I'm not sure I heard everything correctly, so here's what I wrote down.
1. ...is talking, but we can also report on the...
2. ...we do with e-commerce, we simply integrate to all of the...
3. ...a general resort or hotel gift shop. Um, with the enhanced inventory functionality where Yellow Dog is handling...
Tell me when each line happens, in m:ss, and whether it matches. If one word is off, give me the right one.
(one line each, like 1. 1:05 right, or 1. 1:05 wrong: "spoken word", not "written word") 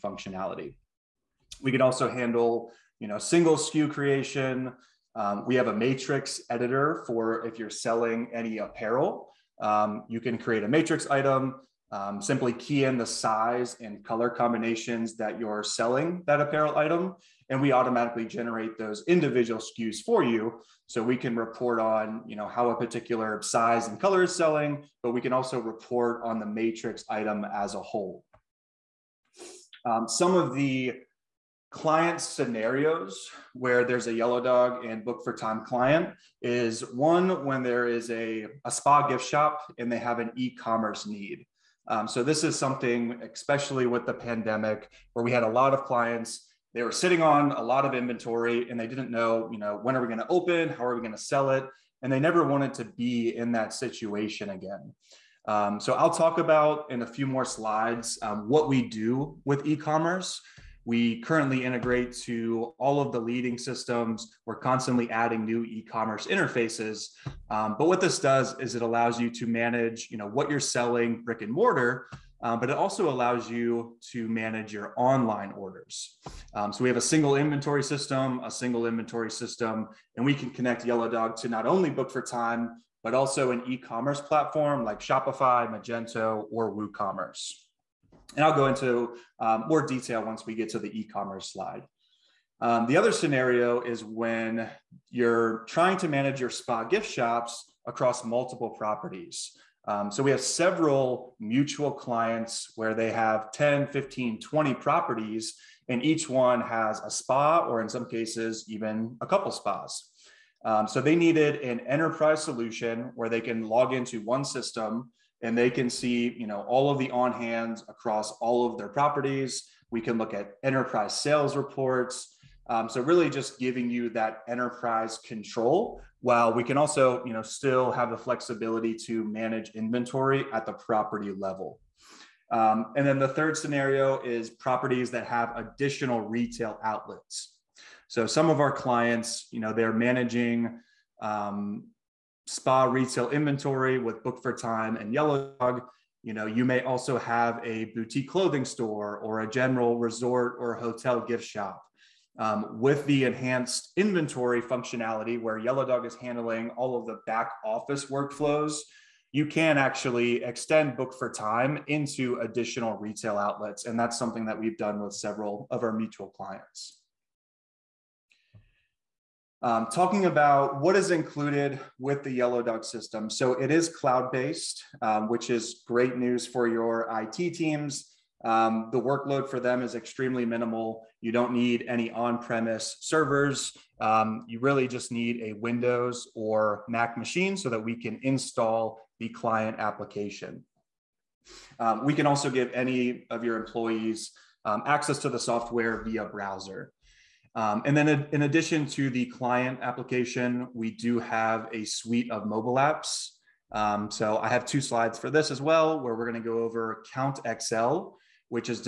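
1. 0:24 wrong: "selling", not "talking"
2. 0:58 wrong: "currently", not "simply"
3. 2:29 right.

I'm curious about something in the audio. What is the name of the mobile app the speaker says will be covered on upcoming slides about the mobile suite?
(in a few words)
Count XL.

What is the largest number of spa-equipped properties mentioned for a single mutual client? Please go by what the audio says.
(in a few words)
20.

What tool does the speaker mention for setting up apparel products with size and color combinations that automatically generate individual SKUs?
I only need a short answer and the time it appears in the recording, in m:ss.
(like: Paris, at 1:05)
Matrix editor, at 0:05.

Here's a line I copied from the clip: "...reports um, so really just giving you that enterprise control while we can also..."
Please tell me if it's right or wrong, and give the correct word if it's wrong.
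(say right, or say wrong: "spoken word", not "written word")
right.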